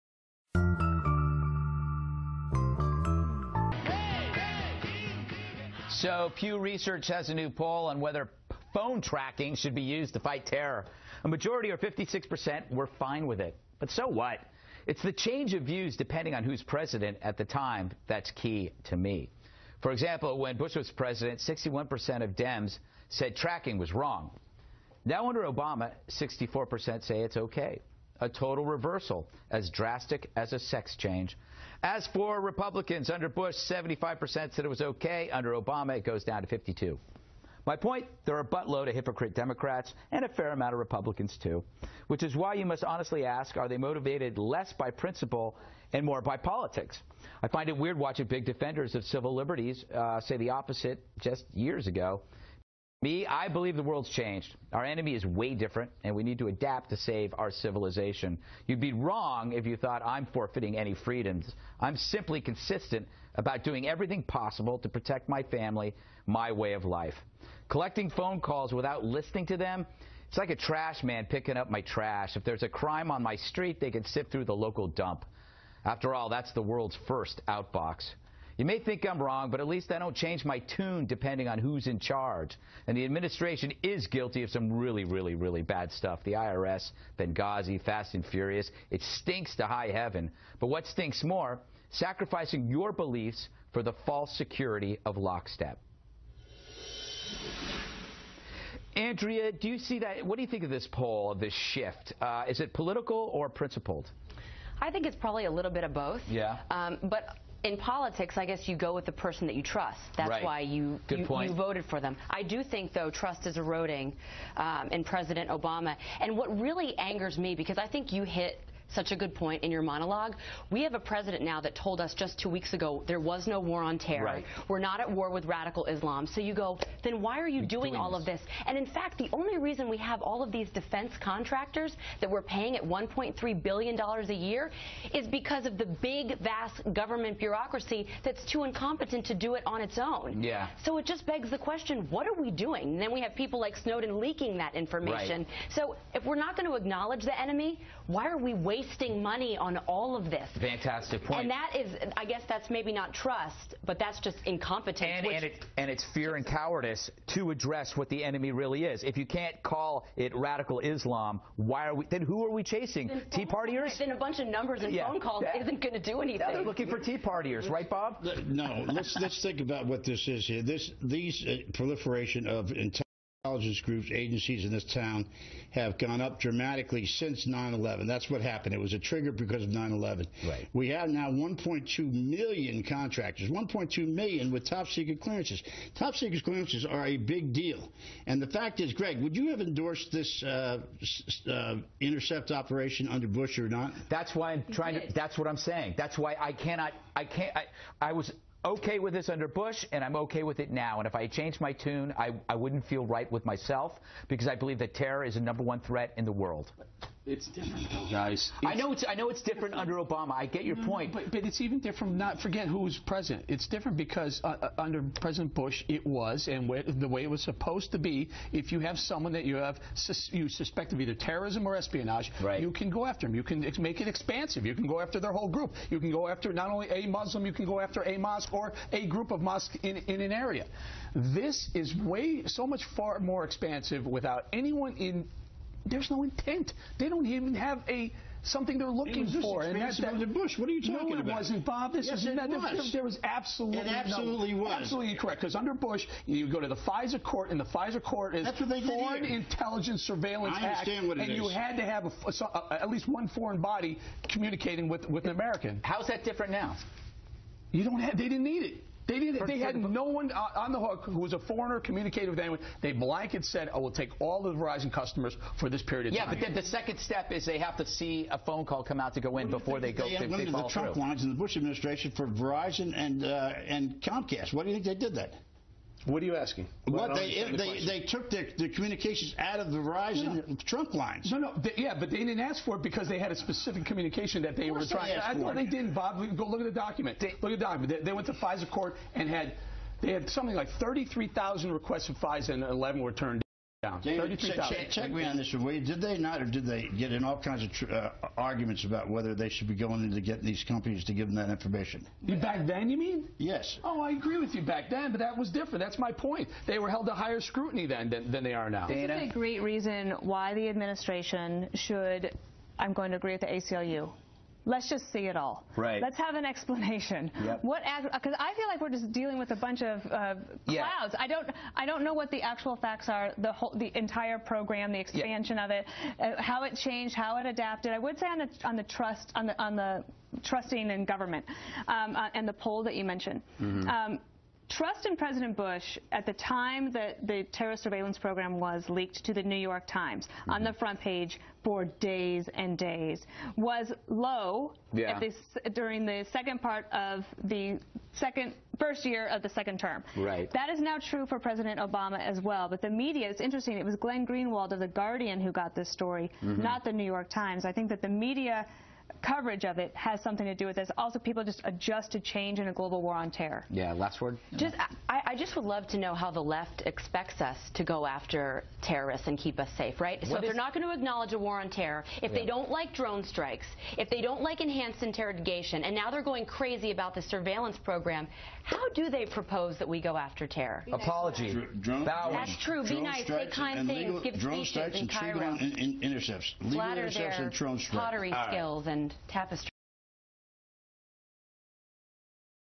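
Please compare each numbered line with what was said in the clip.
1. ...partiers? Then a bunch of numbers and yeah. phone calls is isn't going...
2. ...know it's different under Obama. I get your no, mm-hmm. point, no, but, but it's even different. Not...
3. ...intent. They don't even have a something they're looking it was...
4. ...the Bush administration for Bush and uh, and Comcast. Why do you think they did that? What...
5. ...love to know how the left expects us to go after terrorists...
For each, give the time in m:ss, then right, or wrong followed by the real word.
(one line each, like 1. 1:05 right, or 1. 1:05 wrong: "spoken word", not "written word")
1. 2:43 right
2. 3:29 right
3. 3:56 right
4. 4:31 wrong: "Verizon", not "Bush"
5. 6:05 right.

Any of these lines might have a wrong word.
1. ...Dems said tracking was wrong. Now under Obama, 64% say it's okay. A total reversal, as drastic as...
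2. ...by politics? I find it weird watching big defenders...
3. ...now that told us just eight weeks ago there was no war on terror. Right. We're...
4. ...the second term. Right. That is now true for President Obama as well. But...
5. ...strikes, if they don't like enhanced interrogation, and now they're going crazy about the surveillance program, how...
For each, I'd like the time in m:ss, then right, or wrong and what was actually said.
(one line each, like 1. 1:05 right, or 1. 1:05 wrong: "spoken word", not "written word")
1. 0:22 right
2. 0:46 right
3. 2:01 wrong: "two", not "eight"
4. 5:49 right
5. 6:13 right.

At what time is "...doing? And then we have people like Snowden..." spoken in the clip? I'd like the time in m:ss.
2:22.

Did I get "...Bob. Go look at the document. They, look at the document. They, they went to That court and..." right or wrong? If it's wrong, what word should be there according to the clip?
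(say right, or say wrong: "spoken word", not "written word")
wrong: "FISA", not "That".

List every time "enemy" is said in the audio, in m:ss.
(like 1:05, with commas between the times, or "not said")
0:54, 2:27, 2:38.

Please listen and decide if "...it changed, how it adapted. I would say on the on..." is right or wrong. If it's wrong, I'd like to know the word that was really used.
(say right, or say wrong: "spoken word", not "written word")
right.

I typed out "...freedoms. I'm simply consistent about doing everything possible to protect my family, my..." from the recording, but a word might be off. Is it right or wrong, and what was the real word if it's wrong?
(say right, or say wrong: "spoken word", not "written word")
right.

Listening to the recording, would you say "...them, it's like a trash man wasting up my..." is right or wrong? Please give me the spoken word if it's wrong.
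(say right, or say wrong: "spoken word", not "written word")
wrong: "picking", not "wasting".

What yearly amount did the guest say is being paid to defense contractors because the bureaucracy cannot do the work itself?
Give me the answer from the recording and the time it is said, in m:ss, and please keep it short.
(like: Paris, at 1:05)
$1.3 billion, at 2:12.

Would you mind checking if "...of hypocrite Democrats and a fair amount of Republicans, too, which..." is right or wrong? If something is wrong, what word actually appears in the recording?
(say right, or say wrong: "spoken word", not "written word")
right.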